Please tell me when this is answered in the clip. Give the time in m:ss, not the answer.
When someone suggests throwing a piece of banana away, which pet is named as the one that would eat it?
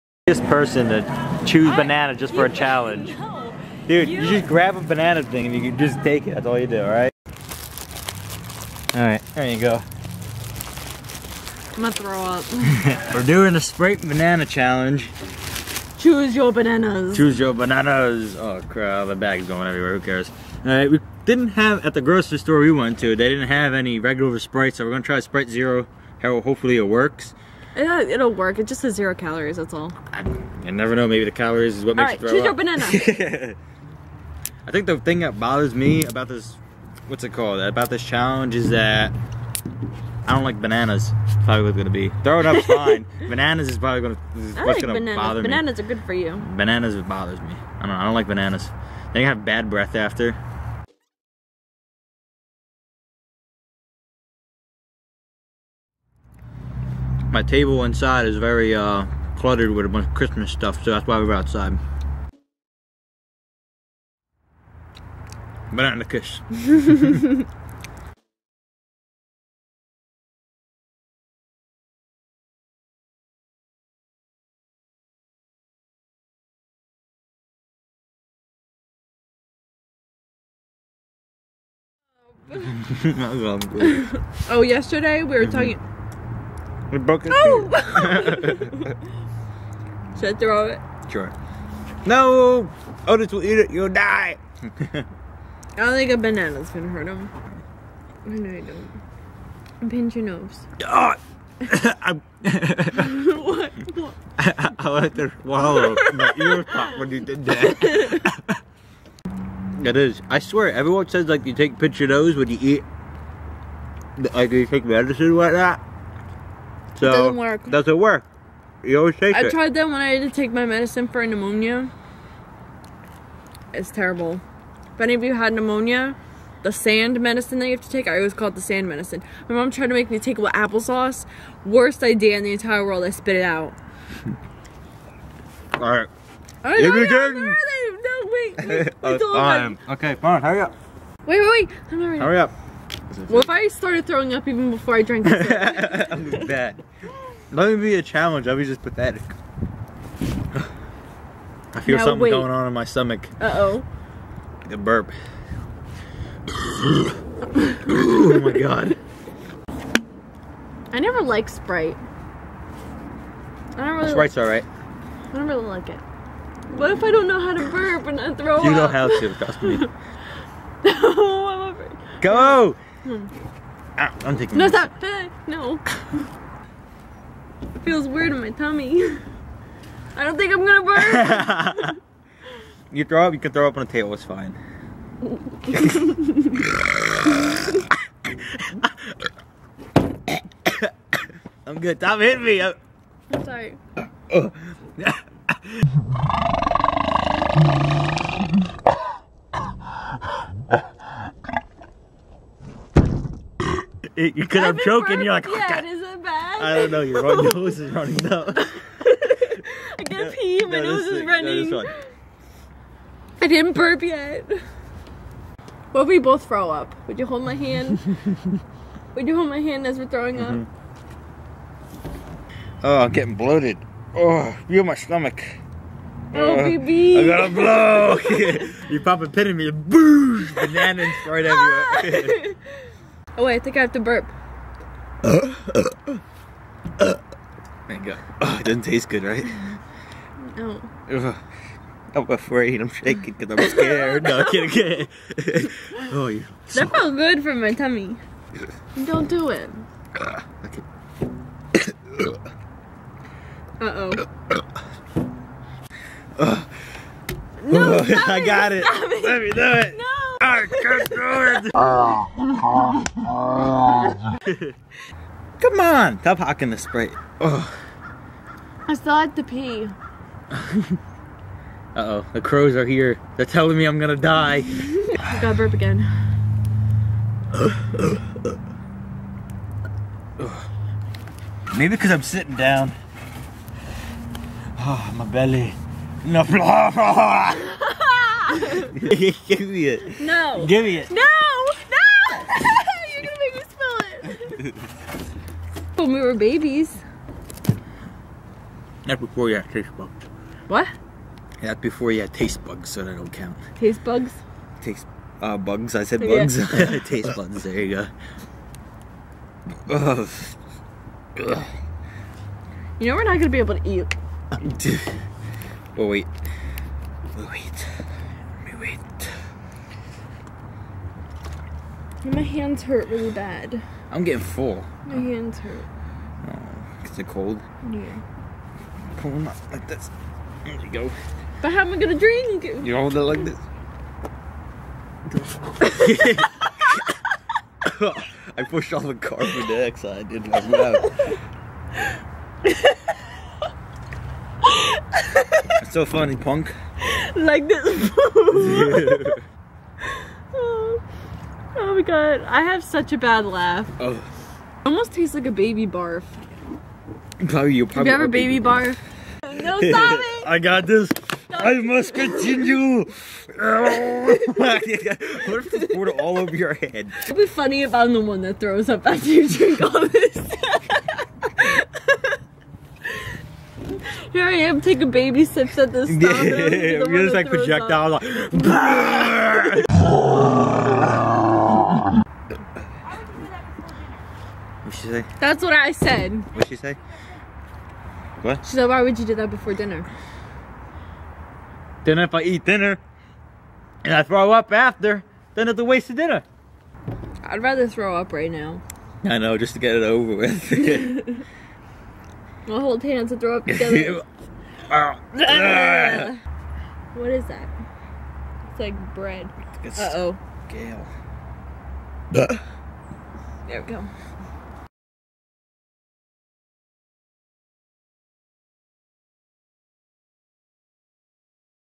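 1:33.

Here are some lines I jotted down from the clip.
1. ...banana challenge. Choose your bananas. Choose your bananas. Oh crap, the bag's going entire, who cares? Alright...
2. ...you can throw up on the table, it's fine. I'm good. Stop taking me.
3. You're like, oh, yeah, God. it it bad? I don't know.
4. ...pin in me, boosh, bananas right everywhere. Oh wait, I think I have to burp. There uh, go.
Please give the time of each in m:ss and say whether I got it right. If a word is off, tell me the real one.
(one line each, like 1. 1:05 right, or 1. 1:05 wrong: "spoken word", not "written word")
1. 0:14 wrong: "everywhere", not "entire"
2. 3:03 wrong: "hitting", not "taking"
3. 3:25 right
4. 3:49 right.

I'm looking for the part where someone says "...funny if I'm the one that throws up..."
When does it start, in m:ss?
6:07.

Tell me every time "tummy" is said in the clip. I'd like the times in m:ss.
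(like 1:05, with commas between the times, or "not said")
2:58, 4:07.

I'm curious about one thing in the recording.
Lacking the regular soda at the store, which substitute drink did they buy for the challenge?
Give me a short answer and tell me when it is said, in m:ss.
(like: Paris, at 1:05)
Sprite Zero, at 0:25.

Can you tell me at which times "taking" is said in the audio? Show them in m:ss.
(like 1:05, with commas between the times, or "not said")
2:54, 6:14.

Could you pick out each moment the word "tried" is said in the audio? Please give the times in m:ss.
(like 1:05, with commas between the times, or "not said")
1:59, 2:09.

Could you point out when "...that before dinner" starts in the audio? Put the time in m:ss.
6:29.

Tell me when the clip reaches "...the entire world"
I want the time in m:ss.
2:12.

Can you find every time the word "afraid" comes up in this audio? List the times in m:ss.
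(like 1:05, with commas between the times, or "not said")
2:51, 4:02.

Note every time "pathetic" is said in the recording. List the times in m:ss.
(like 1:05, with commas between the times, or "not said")
2:28.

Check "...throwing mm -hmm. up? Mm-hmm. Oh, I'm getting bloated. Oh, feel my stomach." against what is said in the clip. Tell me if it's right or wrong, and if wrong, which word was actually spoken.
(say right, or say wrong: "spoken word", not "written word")
right.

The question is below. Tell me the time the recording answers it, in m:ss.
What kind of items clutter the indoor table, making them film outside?
1:00.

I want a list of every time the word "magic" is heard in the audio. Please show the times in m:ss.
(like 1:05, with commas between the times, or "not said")
not said.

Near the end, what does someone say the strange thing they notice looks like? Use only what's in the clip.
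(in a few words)
Bread.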